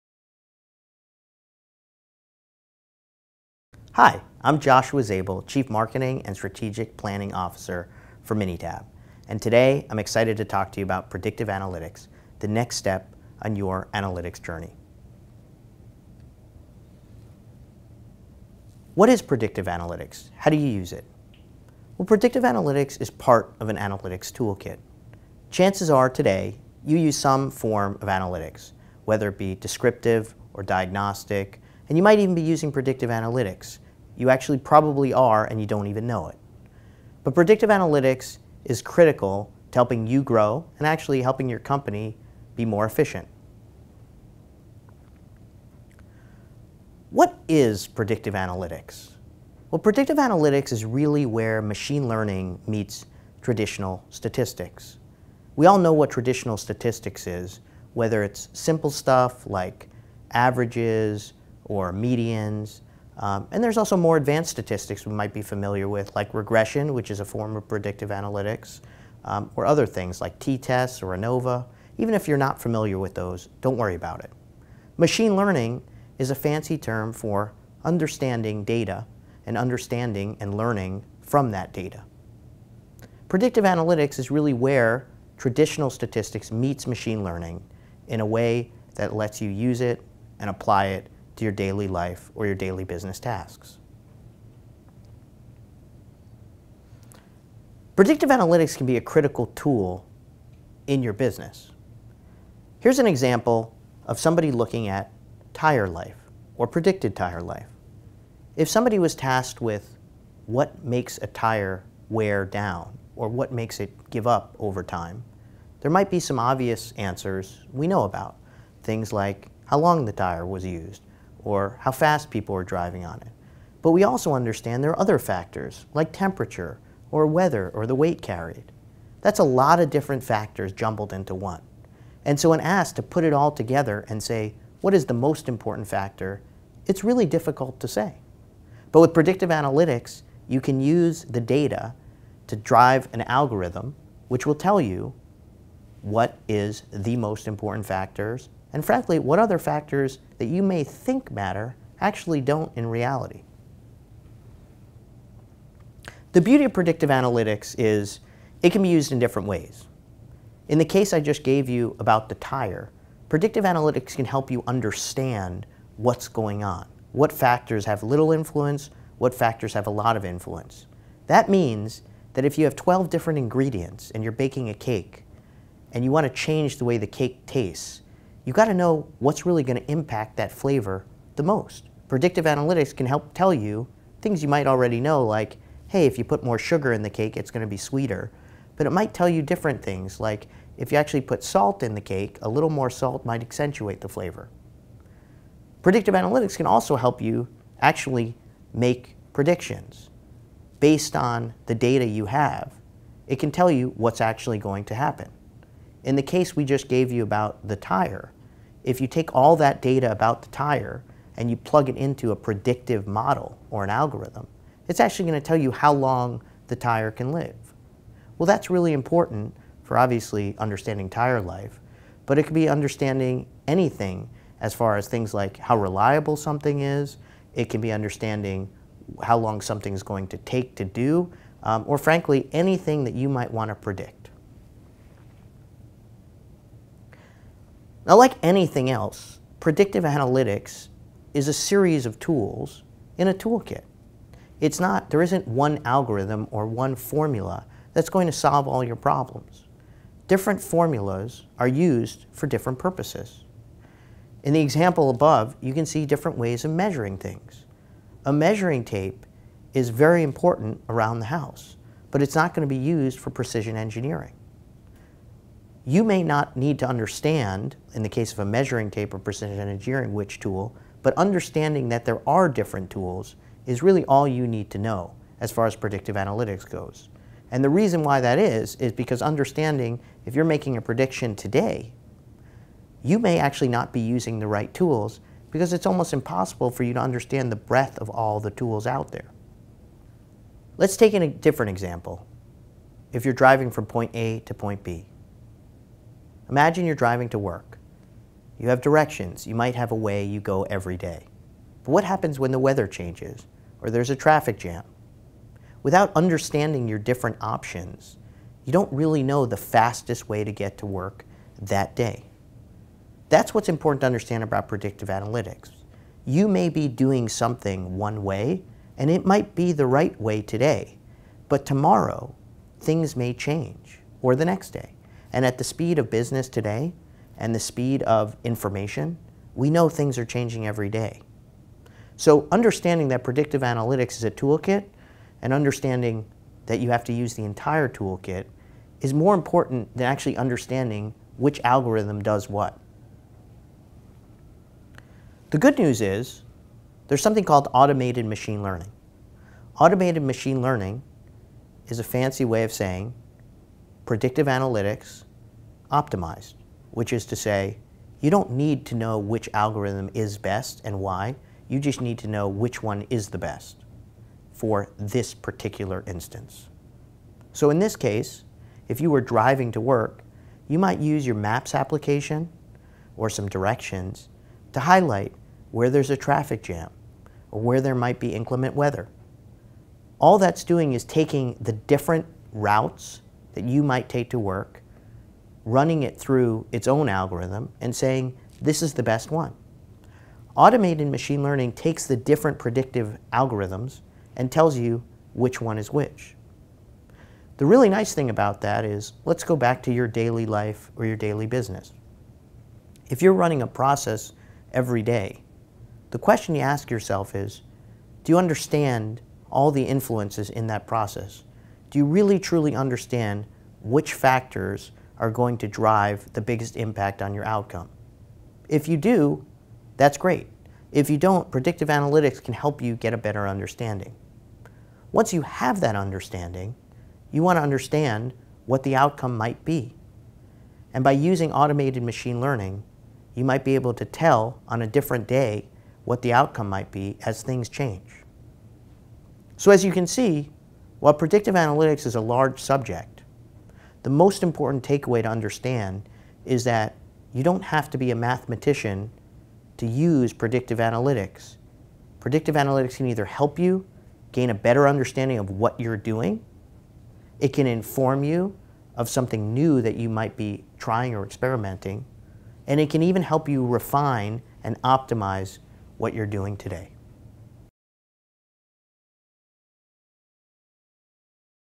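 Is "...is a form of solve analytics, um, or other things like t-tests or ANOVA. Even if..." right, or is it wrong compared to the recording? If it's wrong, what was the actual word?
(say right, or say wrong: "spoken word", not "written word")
wrong: "predictive", not "solve".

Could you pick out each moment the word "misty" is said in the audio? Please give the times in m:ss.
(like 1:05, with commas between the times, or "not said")
not said.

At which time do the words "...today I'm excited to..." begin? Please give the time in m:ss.
0:09.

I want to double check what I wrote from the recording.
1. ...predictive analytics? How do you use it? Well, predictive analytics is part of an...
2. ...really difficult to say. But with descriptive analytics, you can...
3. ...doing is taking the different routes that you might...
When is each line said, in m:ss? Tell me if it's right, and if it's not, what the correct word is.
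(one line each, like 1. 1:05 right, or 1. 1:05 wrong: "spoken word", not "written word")
1. 0:19 right
2. 2:17 wrong: "predictive", not "descriptive"
3. 6:20 right.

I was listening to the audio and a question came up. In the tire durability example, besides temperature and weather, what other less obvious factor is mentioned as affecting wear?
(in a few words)
Weight carried.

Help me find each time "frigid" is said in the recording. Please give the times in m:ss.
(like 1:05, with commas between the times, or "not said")
not said.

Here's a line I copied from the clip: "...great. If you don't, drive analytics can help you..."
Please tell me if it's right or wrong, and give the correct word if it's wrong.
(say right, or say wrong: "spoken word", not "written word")
wrong: "predictive", not "drive".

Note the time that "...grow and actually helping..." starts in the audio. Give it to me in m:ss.
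0:40.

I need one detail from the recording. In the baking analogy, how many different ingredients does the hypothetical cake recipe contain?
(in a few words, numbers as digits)
12.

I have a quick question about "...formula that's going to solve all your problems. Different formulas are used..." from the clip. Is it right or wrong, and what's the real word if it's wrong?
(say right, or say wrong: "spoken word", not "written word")
right.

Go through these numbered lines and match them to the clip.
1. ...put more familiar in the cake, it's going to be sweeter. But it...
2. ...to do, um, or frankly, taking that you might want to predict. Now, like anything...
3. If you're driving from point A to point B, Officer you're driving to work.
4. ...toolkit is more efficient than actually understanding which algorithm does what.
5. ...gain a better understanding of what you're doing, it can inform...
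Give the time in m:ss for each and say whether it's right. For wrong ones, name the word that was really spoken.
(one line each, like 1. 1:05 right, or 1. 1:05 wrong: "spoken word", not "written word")
1. 3:06 wrong: "sugar", not "familiar"
2. 3:50 wrong: "anything", not "taking"
3. 4:53 wrong: "Imagine", not "Officer"
4. 5:37 wrong: "important", not "efficient"
5. 7:34 right.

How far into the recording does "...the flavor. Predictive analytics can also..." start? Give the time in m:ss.
3:14.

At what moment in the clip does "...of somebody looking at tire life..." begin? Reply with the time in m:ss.
1:44.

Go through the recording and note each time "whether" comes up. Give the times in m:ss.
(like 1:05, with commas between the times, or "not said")
0:29, 0:57.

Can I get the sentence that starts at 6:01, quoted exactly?
You just need to know which one is the best for this particular instance.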